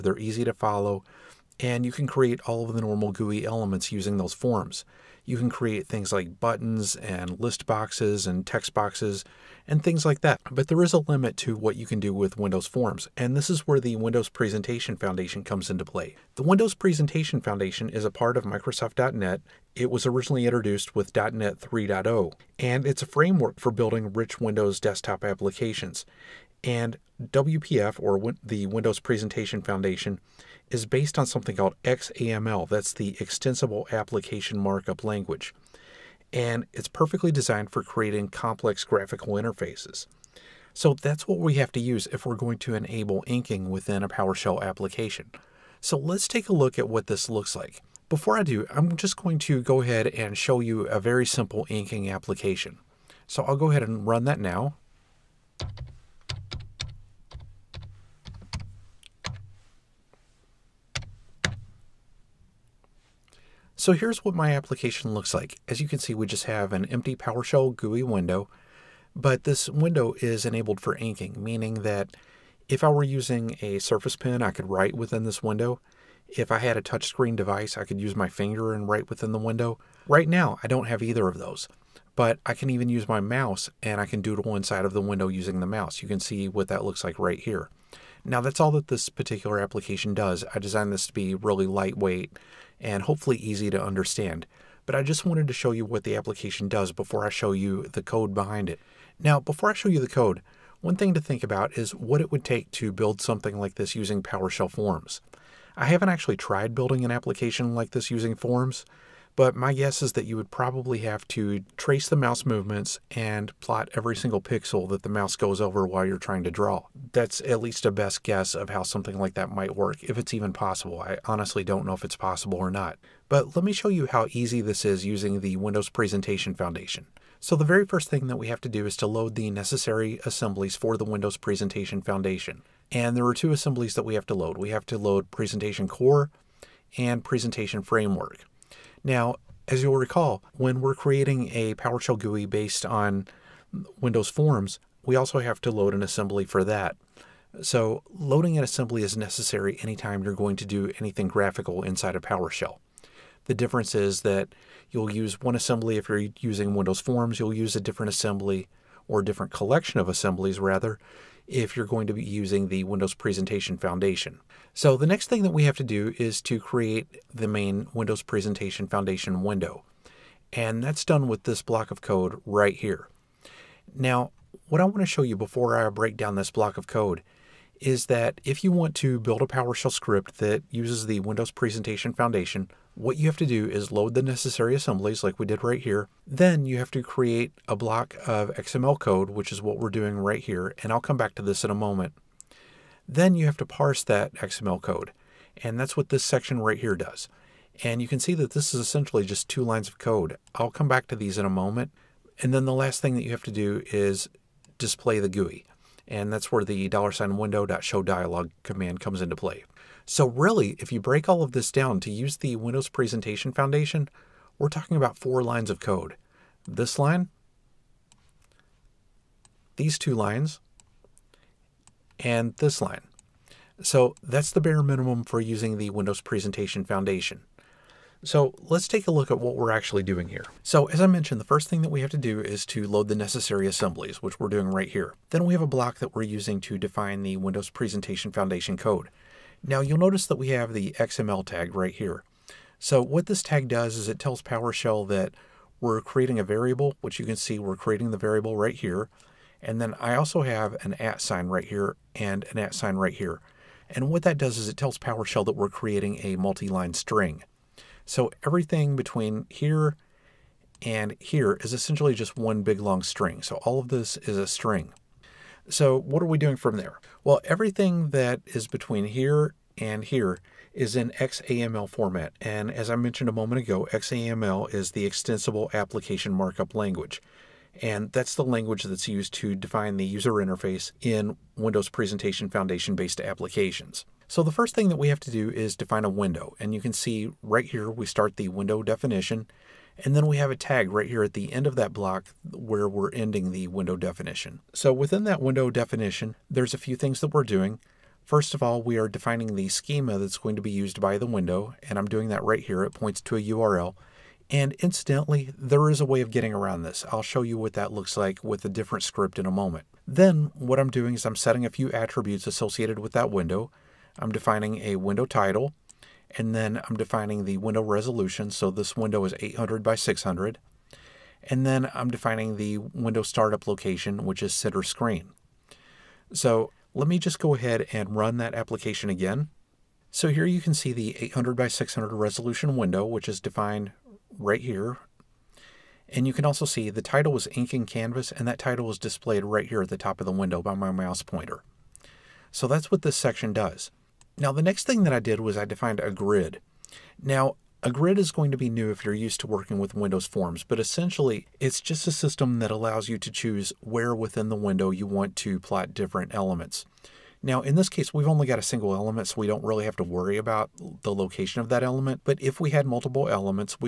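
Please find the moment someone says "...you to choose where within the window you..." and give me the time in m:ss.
5:53.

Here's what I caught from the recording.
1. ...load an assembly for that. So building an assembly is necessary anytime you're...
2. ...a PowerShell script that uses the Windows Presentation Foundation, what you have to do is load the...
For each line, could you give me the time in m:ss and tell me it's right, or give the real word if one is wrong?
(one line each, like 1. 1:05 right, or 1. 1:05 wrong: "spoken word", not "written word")
1. 2:25 wrong: "loading", not "building"
2. 2:59 right.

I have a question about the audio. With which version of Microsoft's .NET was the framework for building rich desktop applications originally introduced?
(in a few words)
.NET 3.0.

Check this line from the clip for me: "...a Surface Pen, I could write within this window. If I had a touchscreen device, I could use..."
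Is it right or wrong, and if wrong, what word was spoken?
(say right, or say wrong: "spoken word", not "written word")
right.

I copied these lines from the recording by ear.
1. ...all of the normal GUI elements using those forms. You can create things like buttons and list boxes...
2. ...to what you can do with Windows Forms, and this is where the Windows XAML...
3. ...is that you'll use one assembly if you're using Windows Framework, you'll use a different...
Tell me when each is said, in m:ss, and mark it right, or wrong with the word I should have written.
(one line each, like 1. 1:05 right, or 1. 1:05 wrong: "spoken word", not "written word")
1. 0:02 right
2. 0:11 wrong: "Presentation", not "XAML"
3. 2:33 wrong: "Forms", not "Framework".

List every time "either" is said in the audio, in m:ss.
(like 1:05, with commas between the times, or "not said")
1:21.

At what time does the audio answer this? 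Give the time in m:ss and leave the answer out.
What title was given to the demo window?
5:37.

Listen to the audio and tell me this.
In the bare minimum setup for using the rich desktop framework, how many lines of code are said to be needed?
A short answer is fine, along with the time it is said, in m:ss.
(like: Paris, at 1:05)
4, at 3:35.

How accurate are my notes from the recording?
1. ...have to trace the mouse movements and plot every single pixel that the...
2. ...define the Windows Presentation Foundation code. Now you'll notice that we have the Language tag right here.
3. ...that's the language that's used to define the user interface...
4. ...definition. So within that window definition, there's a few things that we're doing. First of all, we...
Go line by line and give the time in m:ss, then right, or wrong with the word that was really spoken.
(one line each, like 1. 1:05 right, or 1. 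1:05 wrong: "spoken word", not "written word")
1. 1:50 right
2. 3:56 wrong: "XML", not "Language"
3. 4:38 right
4. 4:53 right.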